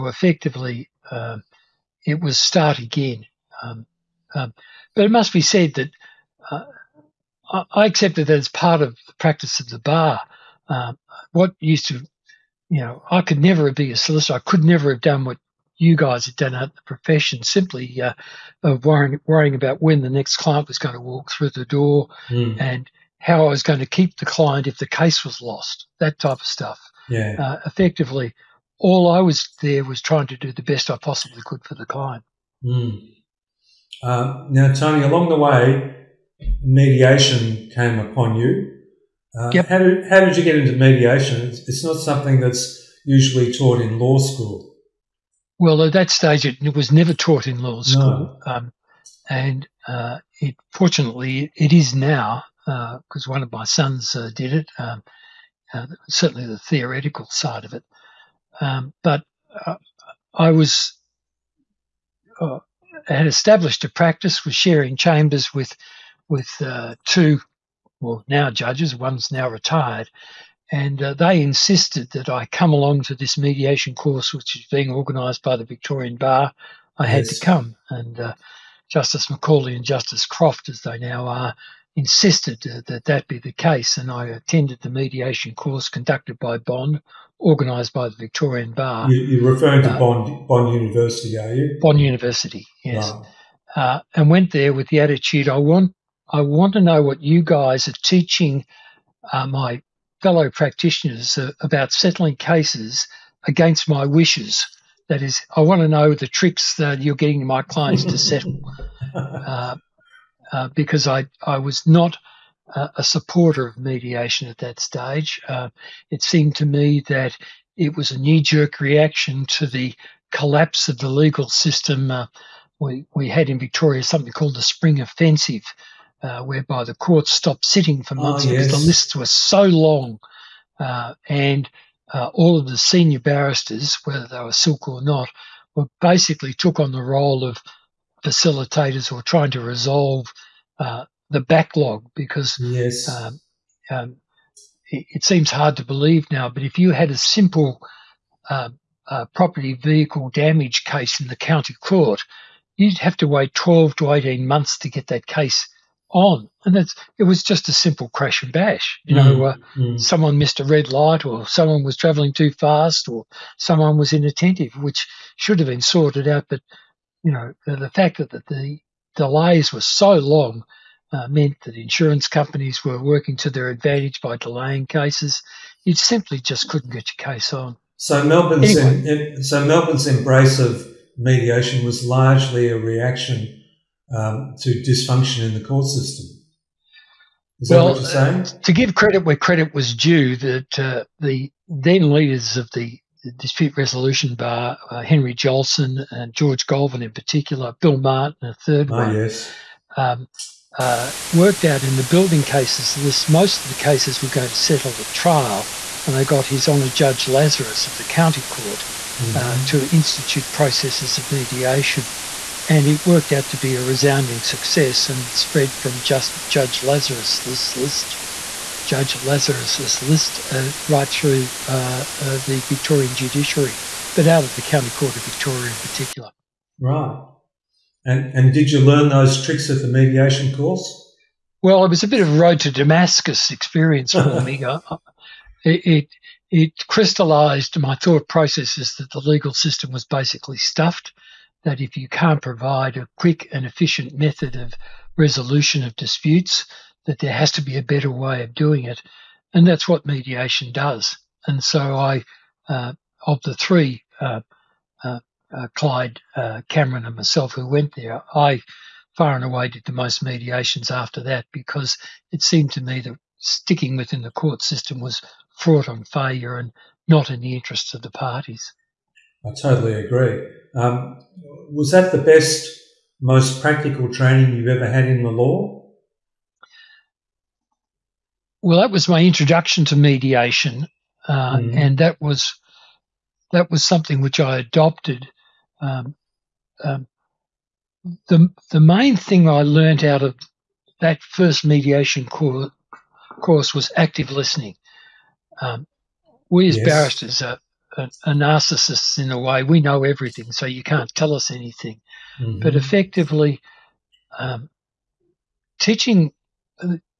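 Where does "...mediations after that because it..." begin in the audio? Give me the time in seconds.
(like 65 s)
260 s.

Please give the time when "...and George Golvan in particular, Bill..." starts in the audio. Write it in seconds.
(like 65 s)
196 s.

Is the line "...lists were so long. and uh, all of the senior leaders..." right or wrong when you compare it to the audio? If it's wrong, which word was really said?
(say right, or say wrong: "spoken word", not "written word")
wrong: "barristers", not "leaders".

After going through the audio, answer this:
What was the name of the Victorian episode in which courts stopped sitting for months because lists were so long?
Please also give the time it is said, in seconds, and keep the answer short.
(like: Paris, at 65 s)
Spring Offensive, at 124 s.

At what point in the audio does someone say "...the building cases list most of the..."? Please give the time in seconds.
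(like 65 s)
201 s.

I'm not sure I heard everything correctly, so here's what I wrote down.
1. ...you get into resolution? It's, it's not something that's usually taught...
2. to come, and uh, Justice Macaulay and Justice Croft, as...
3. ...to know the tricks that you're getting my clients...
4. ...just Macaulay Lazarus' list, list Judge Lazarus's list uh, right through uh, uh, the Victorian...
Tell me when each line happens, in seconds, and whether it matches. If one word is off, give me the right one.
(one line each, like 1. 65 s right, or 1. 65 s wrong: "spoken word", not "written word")
1. 40 s wrong: "mediation", not "resolution"
2. 77 s right
3. 105 s right
4. 216 s wrong: "Judge", not "Macaulay".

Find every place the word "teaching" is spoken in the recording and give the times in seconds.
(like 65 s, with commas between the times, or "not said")
98 s, 305 s.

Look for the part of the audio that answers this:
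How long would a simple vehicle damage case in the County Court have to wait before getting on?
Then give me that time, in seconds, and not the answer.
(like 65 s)
153 s.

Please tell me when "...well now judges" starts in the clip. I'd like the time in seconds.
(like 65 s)
68 s.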